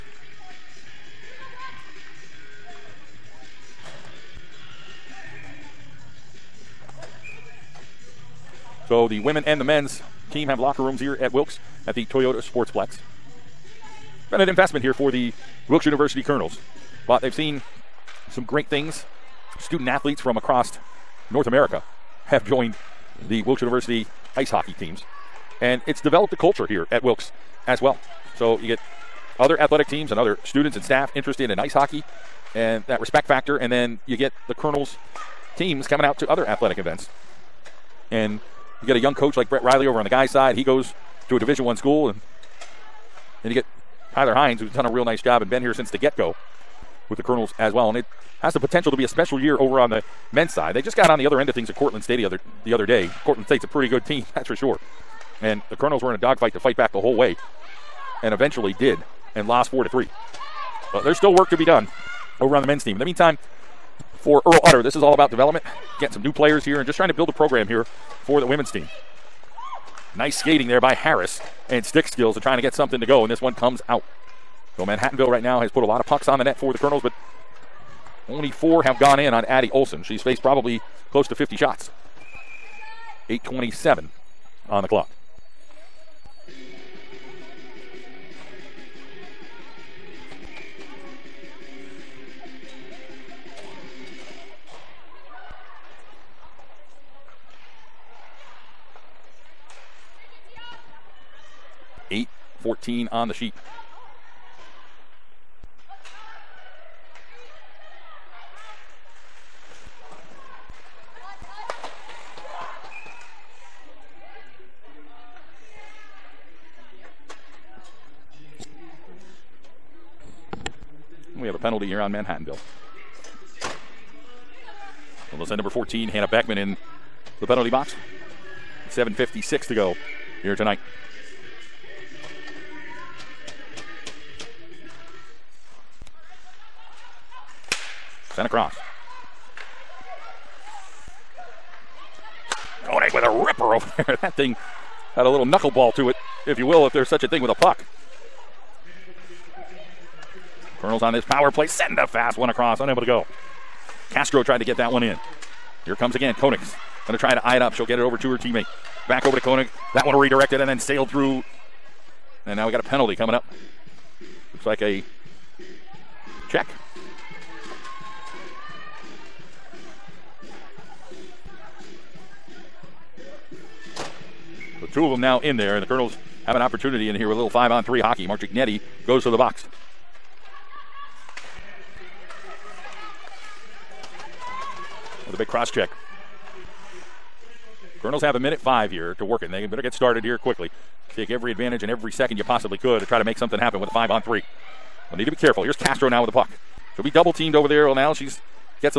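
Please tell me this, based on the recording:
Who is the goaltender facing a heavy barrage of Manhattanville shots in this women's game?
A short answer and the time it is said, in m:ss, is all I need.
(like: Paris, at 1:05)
Addie Olson, at 1:19.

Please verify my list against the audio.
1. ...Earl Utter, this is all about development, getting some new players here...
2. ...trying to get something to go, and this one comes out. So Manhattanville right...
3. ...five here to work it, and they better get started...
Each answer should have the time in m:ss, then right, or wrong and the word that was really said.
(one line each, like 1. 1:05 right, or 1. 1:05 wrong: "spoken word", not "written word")
1. 1:04 right
2. 1:12 right
3. 3:08 right.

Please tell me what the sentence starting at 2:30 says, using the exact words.
Colonels on this power play, sending a fast one across, unable to go.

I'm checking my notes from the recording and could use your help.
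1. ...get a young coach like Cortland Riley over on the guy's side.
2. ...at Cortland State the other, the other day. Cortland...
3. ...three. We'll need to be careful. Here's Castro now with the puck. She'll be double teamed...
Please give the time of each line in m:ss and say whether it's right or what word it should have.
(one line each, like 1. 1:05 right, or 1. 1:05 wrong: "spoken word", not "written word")
1. 0:38 wrong: "Brett", not "Cortland"
2. 0:51 right
3. 3:14 right.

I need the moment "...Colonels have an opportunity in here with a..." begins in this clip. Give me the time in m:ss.
2:55.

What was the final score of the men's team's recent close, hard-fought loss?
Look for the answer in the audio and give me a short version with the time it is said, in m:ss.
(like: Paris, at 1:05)
4 to 3, at 0:59.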